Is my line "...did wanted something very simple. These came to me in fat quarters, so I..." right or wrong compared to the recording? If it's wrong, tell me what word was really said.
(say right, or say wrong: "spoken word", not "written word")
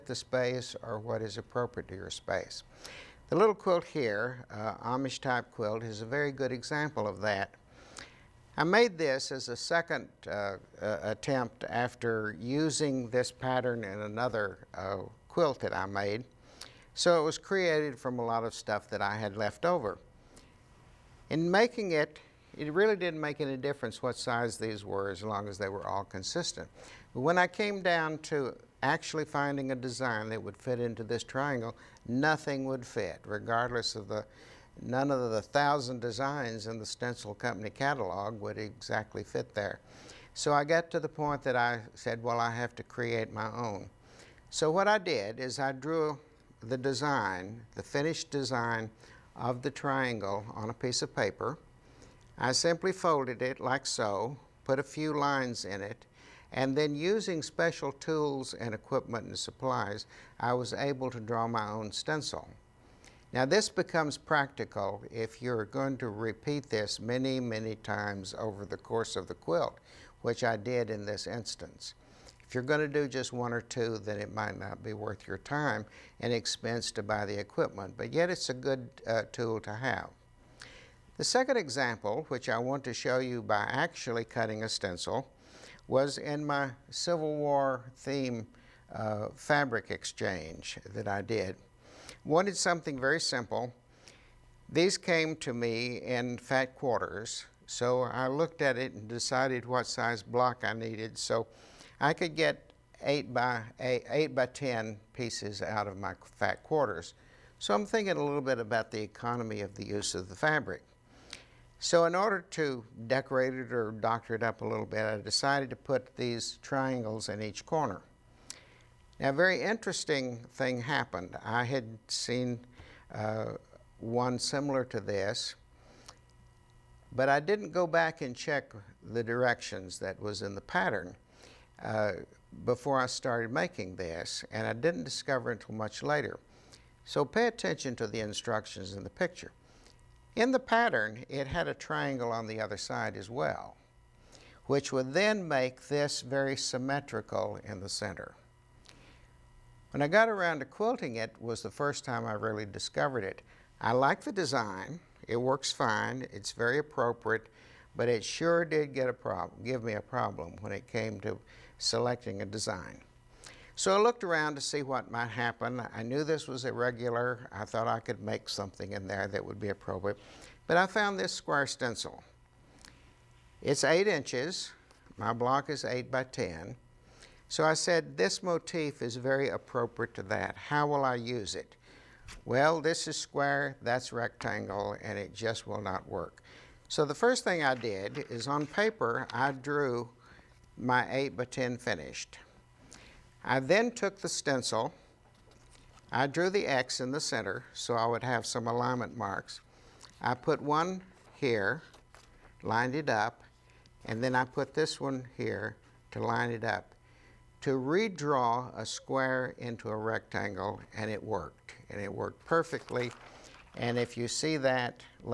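right.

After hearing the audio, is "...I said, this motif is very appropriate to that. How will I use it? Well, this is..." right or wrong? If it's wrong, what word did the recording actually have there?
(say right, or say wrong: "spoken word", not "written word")
right.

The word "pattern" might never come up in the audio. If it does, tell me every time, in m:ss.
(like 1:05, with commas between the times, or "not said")
0:13, 2:10, 2:20.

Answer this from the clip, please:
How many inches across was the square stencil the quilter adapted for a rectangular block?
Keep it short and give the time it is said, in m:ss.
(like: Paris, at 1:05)
8, at 2:53.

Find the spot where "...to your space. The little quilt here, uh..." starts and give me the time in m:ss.
0:01.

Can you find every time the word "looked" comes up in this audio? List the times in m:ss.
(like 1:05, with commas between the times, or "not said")
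1:38, 2:44.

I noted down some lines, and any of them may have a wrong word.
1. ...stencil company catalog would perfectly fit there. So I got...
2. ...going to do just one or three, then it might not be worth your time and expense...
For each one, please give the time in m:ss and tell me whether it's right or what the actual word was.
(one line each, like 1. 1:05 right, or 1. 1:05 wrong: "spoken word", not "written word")
1. 0:36 wrong: "exactly", not "perfectly"
2. 1:12 wrong: "two", not "three".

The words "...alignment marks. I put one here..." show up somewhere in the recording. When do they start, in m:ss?
3:18.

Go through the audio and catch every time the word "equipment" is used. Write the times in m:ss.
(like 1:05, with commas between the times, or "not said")
0:58, 1:17.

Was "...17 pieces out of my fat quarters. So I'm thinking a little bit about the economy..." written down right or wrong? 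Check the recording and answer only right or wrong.
wrong.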